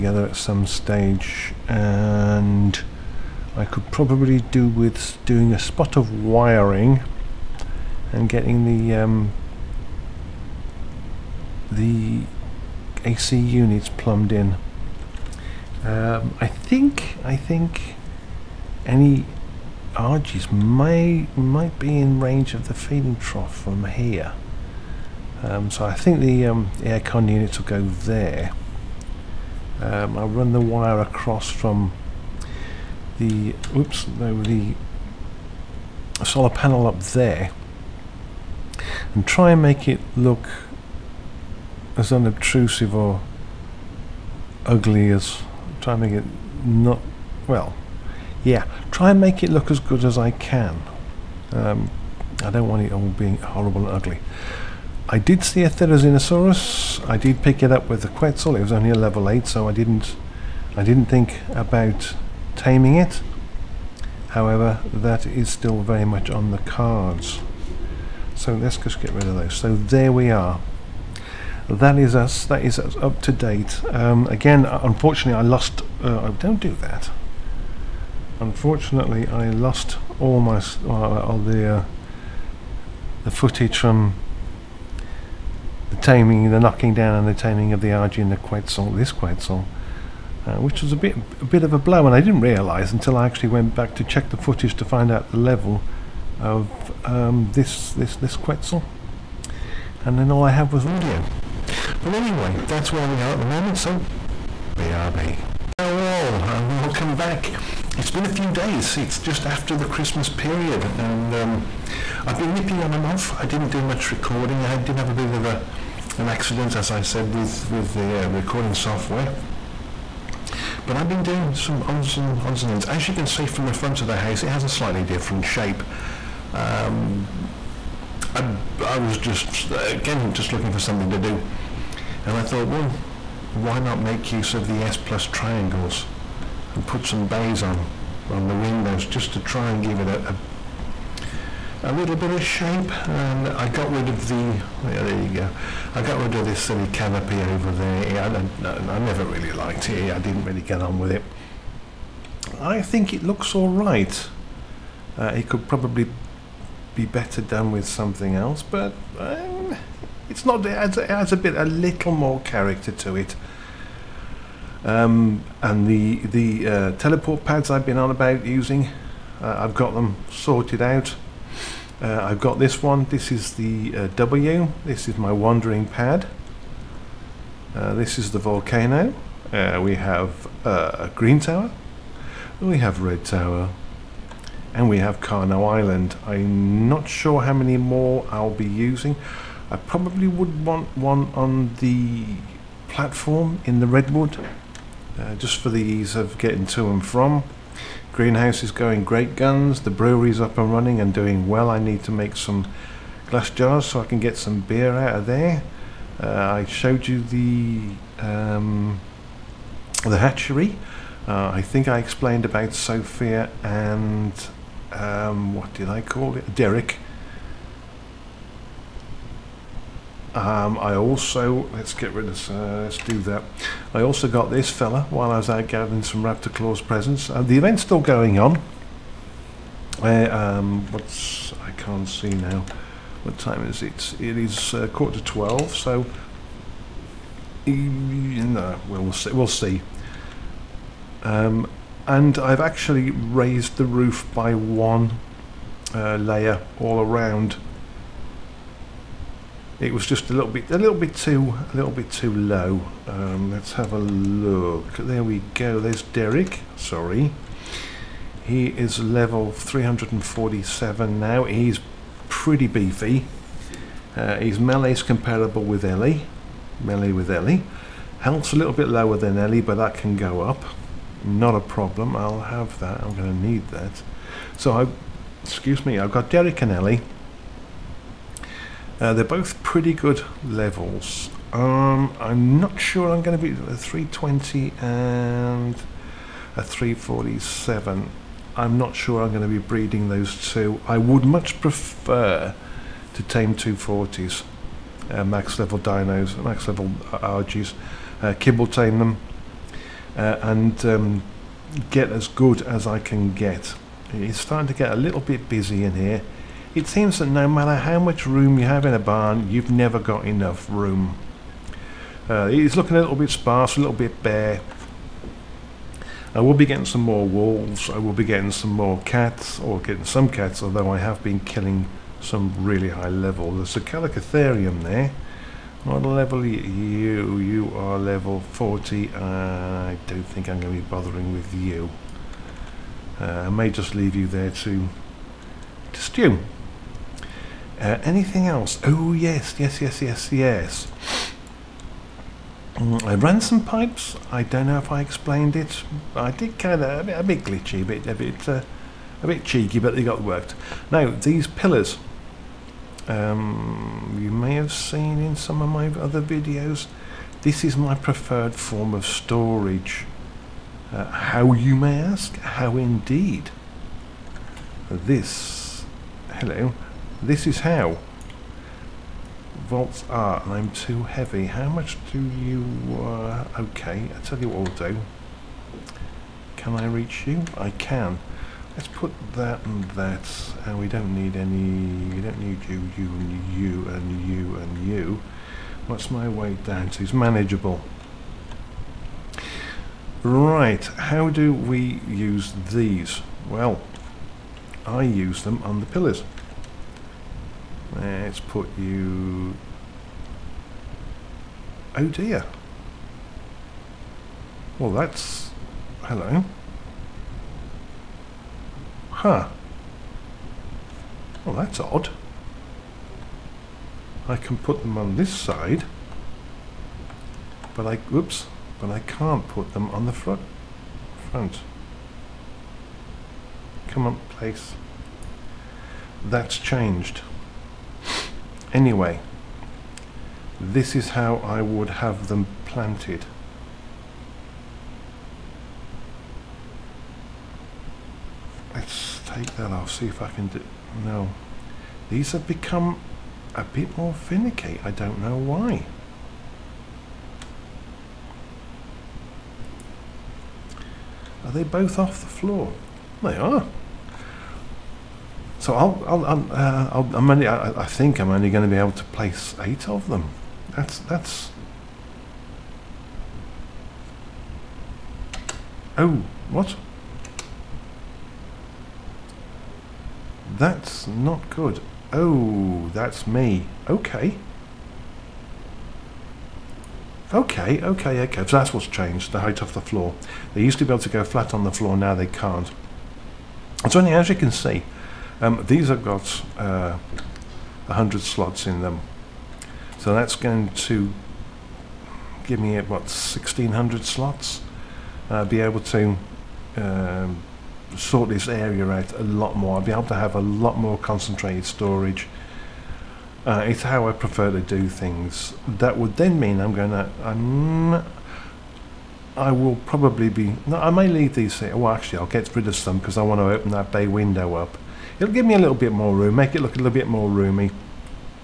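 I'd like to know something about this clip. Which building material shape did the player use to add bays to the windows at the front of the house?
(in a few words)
S plus triangles.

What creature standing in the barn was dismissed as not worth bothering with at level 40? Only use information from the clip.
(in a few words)
Calicotherium.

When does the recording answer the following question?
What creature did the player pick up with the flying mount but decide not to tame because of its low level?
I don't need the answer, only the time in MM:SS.
00:55.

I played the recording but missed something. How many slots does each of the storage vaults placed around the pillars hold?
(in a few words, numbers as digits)
100.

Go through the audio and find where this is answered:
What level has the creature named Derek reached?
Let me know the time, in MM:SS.
04:18.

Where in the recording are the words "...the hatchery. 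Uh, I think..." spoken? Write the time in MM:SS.
03:30.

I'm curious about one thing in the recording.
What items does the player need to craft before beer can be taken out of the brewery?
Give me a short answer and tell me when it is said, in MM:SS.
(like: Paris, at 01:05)
glass jars, at 03:23.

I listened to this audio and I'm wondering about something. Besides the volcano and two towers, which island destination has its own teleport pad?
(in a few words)
Carno Island.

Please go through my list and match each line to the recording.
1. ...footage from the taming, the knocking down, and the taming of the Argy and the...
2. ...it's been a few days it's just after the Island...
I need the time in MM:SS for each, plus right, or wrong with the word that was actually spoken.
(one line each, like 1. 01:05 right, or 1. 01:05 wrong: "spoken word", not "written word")
1. 01:23 right
2. 01:47 wrong: "Christmas", not "Island".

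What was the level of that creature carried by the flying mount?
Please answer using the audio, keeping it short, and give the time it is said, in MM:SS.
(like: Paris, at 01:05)
8, at 00:58.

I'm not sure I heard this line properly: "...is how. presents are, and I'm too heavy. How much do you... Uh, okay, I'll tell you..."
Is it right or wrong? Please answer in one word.
wrong.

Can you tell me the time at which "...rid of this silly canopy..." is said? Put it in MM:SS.
02:26.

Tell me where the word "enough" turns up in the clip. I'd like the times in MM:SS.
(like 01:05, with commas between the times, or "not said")
05:10.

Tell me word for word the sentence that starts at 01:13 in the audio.
Um, again, uh, unfortunately, I lost.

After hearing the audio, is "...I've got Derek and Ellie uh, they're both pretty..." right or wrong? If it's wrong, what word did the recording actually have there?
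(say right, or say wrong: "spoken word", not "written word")
right.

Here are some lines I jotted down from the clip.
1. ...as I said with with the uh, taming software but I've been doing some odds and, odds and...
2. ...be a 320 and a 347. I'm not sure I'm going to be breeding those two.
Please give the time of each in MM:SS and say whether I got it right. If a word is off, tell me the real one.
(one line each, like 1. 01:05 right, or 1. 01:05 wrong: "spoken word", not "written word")
1. 01:56 wrong: "recording", not "taming"
2. 04:43 right.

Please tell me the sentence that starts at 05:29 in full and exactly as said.
I don't think I'm going to be bothering with you.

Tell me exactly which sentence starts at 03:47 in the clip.
Uh, the event's still going on.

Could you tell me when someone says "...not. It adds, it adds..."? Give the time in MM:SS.
02:40.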